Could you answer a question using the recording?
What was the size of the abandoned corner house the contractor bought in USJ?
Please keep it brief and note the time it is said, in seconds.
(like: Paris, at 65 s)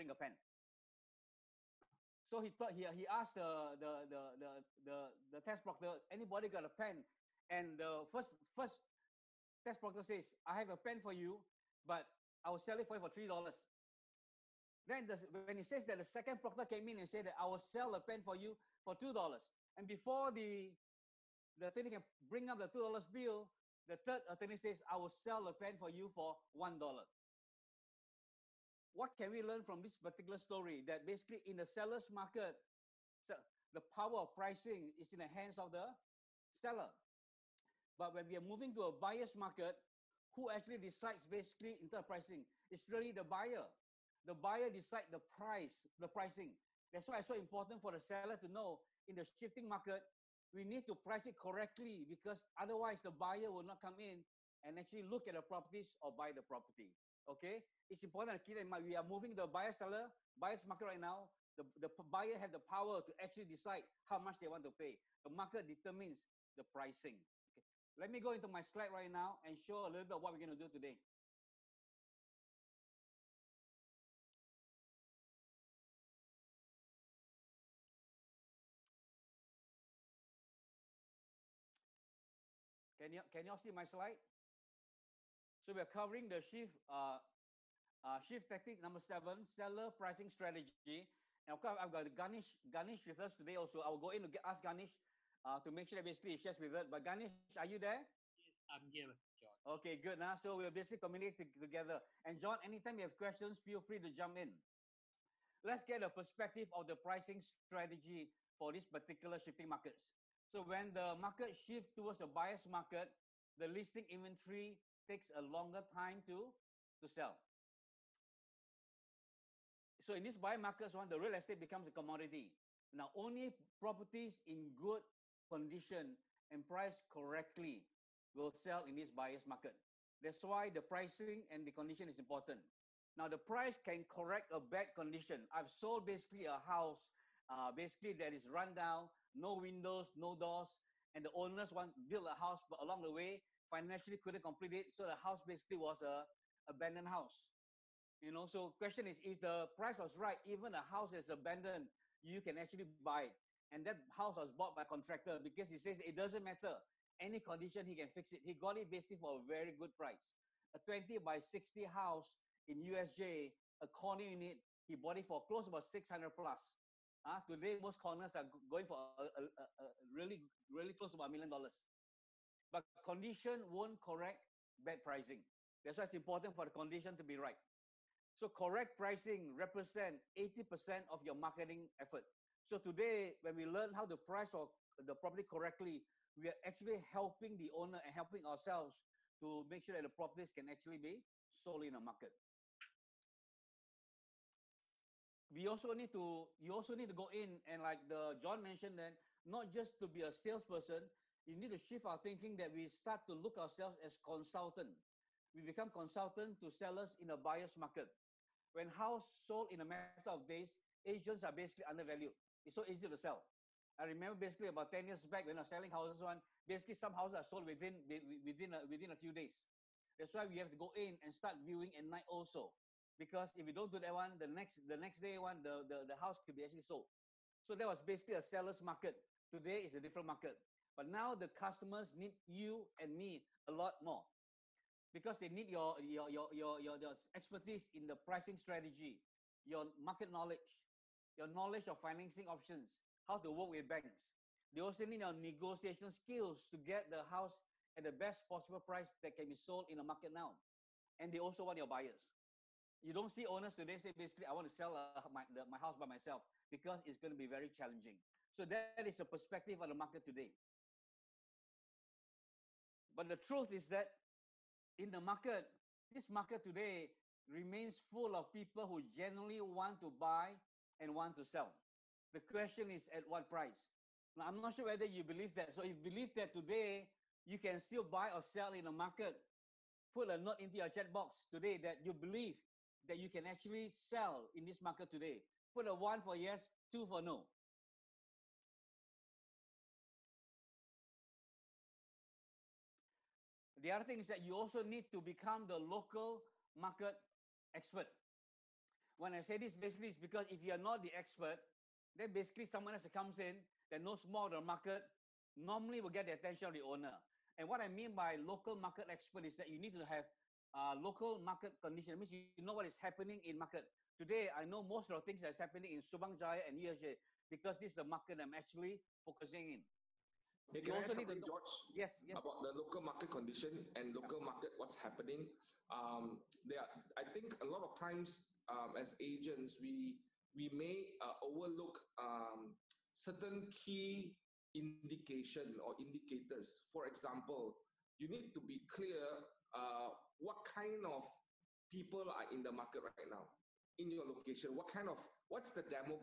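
20 by 60, at 160 s.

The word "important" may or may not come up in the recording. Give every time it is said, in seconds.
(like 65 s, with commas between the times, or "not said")
47 s, 58 s, 132 s, 176 s.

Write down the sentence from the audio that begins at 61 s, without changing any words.
The, the buyer have the power to actually decide how much they want to pay.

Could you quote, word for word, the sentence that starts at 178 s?
So correct pricing represent 80% of your marketing effort.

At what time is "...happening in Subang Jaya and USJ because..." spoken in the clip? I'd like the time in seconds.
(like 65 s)
315 s.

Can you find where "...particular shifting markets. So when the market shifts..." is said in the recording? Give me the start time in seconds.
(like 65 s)
108 s.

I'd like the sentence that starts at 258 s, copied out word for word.
So that is the perspective of the market today.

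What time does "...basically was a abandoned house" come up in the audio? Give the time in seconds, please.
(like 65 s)
145 s.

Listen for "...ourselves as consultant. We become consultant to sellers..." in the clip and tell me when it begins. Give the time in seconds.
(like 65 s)
203 s.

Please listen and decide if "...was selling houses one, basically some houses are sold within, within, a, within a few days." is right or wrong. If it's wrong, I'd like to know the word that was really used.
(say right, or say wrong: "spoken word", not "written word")
right.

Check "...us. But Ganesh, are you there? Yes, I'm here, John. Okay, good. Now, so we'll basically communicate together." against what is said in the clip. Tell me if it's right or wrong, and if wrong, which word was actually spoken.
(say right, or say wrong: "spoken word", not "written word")
right.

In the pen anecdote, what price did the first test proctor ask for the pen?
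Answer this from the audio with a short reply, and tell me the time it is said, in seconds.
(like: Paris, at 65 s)
$3, at 13 s.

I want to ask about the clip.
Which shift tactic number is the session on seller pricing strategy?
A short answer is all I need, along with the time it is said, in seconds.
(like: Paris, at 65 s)
7, at 88 s.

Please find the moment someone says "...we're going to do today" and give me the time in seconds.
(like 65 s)
70 s.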